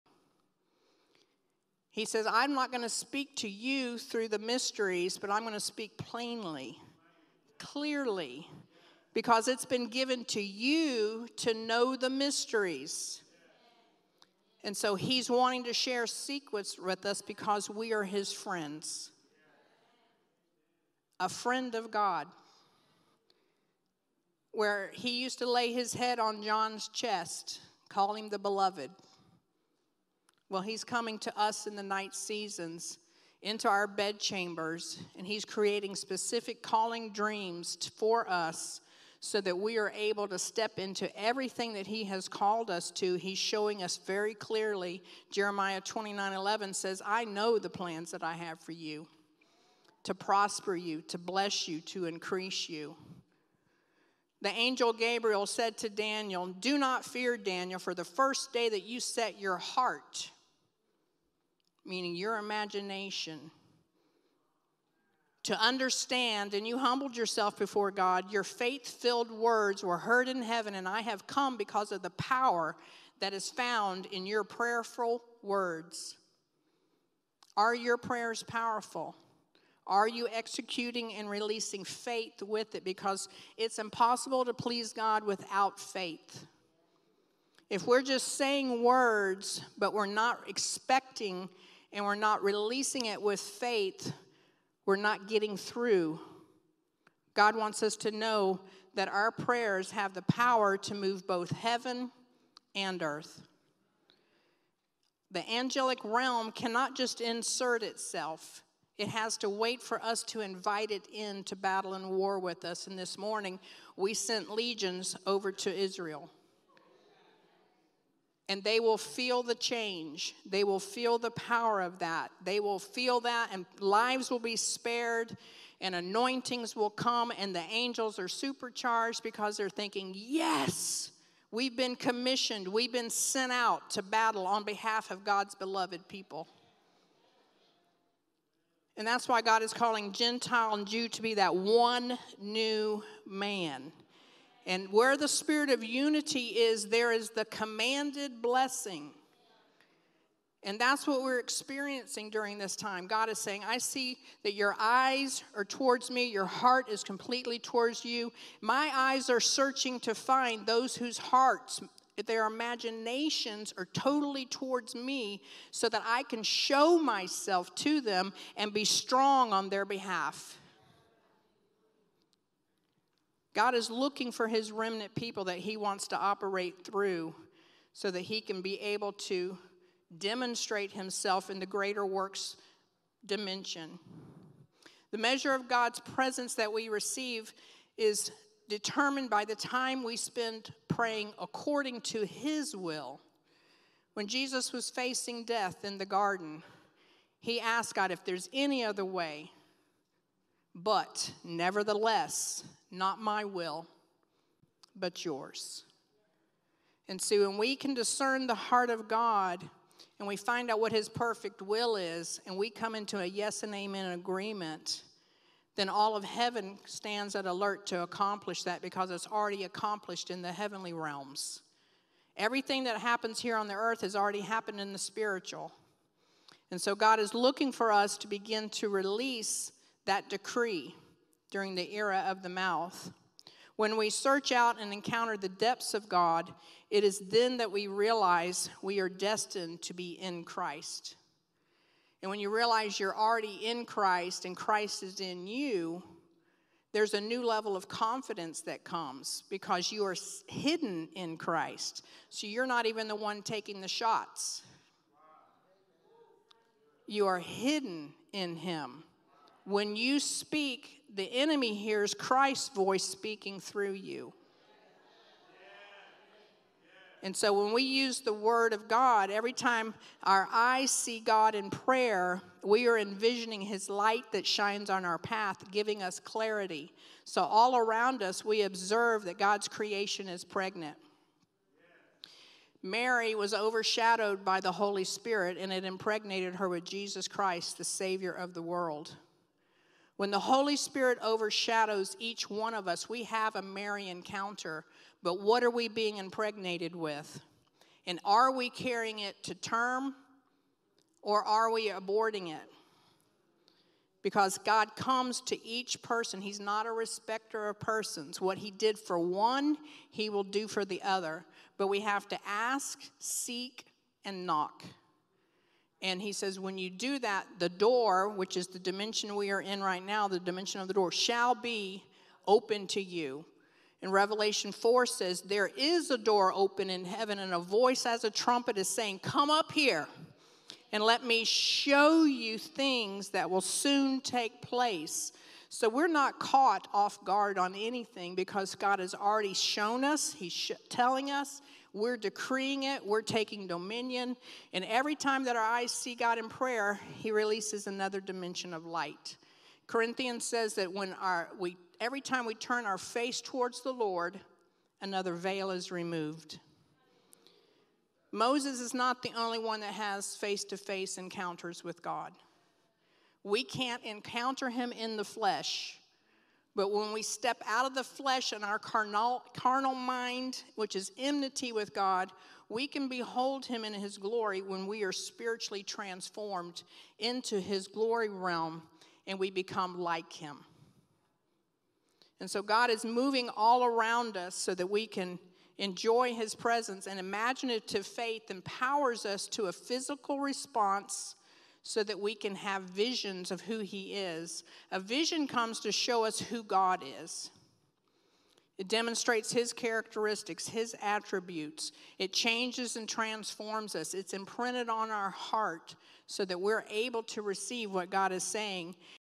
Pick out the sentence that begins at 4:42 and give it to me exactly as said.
Mary was overshadowed by the Holy Spirit, and it impregnated her with Jesus Christ, the Savior of the world.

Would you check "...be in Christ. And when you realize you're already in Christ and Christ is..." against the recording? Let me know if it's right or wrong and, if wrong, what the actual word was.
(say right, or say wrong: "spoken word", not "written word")
right.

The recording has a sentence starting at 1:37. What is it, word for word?
God wants us to know that our prayers have the power to move both heaven and earth.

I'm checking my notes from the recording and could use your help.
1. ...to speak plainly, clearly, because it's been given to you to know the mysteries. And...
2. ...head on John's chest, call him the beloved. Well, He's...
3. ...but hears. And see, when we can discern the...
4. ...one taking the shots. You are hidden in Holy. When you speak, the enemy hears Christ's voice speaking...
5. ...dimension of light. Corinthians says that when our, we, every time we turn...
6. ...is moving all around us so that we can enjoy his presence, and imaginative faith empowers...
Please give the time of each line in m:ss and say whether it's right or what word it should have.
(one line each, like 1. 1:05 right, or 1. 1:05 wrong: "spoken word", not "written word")
1. 0:05 right
2. 0:25 right
3. 3:24 wrong: "yours", not "hears"
4. 4:13 wrong: "Him", not "Holy"
5. 5:48 right
6. 6:22 right.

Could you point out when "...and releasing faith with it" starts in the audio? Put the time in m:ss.
1:21.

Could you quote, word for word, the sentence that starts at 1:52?
And this morning, we sent legions over to Israel and they will feel the change.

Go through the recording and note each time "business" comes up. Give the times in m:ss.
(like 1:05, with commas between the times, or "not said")
not said.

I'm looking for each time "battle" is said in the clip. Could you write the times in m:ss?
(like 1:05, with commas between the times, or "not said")
1:51, 2:14.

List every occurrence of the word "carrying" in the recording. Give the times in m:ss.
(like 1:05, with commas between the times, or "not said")
4:58.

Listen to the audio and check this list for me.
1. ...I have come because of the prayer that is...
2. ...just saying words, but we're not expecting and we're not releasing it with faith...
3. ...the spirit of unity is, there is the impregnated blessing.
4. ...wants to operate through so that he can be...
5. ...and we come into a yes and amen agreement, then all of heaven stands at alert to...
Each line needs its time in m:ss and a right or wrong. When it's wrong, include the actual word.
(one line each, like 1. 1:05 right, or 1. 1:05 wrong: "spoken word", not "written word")
1. 1:10 wrong: "power", not "prayer"
2. 1:28 right
3. 2:25 wrong: "commanded", not "impregnated"
4. 2:55 right
5. 3:32 right.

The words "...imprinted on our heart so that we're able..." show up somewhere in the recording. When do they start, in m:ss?
6:44.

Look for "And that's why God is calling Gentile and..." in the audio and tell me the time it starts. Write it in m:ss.
2:18.